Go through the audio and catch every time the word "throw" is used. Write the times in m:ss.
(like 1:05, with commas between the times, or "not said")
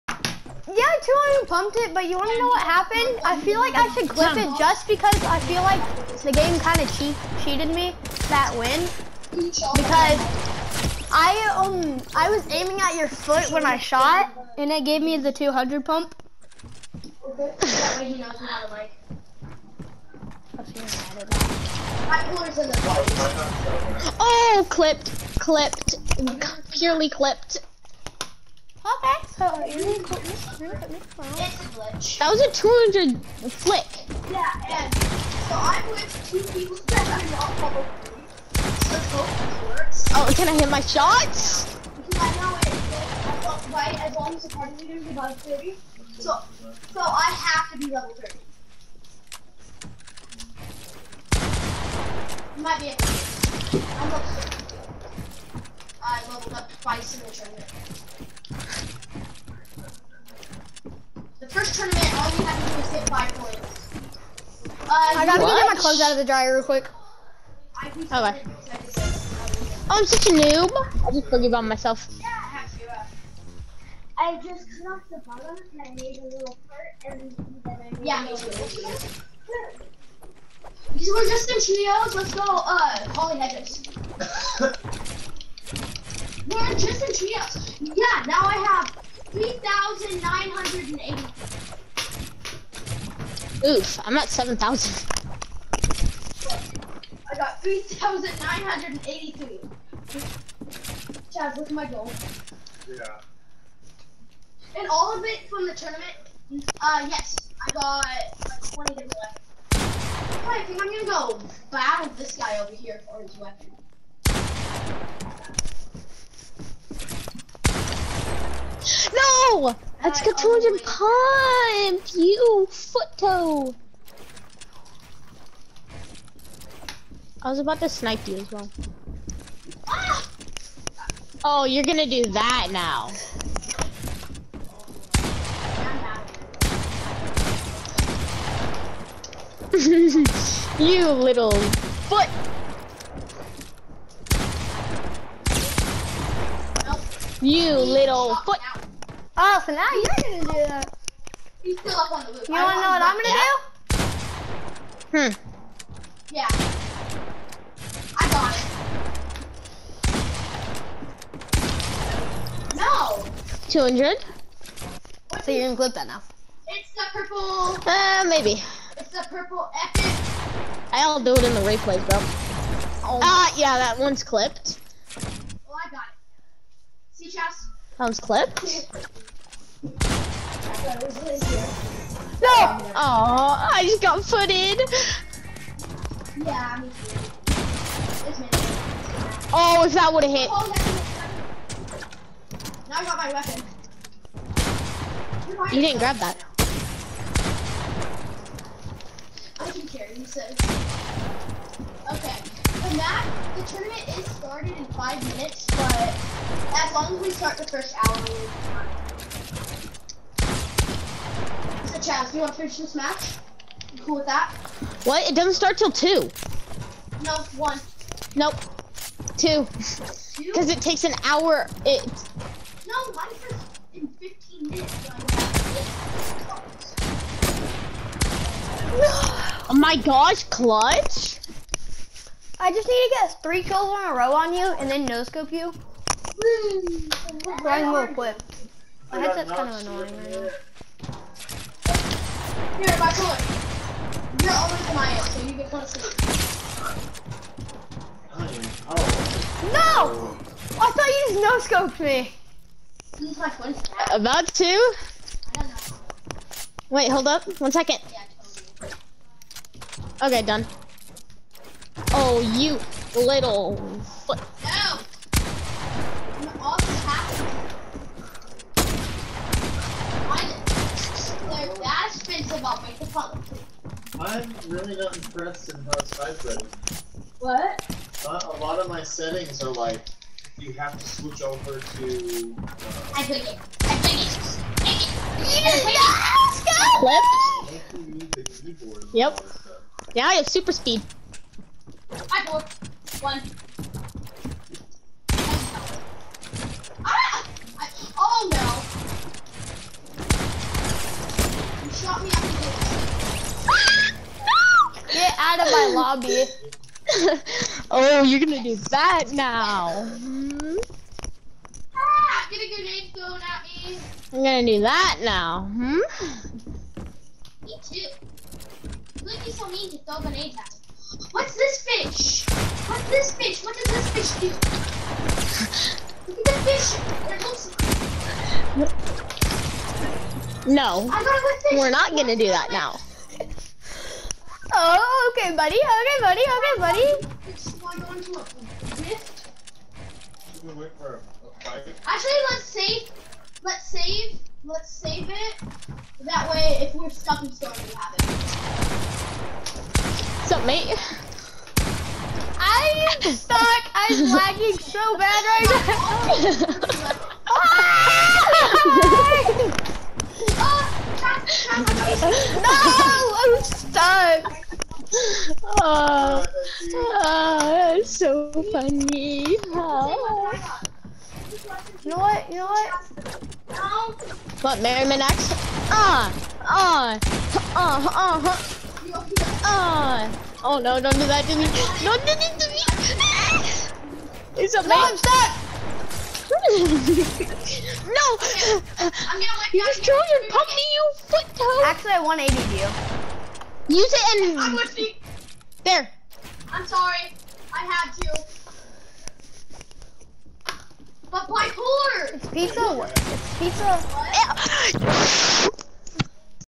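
5:19.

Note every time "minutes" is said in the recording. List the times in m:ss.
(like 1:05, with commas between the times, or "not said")
3:25, 3:44.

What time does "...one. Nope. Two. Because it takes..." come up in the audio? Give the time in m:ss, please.
3:37.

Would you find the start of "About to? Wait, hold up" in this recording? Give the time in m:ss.
4:14.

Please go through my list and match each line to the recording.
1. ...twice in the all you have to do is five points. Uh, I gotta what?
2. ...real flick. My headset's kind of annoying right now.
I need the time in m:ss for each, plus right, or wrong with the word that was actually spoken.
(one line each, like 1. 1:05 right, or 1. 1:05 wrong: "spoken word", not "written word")
1. 0:56 right
2. 3:57 wrong: "quick", not "flick".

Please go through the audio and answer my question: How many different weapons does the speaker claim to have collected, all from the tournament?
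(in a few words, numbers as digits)
20.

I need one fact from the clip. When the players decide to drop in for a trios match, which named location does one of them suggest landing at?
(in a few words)
Holly Hedges.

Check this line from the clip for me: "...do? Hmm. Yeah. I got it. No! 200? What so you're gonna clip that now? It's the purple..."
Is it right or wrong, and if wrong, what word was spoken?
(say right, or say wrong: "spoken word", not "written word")
right.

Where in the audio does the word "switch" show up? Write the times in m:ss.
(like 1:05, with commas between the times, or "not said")
4:41.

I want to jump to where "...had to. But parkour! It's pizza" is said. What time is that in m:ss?
6:37.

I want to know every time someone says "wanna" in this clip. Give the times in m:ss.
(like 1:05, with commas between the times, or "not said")
0:02, 2:32.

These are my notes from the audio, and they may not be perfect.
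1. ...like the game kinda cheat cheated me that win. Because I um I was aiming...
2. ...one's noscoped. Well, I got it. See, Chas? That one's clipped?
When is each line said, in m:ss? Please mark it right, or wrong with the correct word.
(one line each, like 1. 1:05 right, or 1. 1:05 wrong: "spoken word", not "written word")
1. 0:05 right
2. 2:53 wrong: "clipped", not "noscoped".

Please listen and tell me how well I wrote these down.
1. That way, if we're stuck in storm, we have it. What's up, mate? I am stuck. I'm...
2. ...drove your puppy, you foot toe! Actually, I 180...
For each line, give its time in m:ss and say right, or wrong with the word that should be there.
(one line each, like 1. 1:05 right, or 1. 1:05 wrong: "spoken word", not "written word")
1. 5:46 right
2. 6:30 right.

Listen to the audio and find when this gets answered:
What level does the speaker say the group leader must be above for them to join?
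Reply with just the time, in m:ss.
0:45.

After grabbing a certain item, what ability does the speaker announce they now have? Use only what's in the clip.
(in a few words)
super speed.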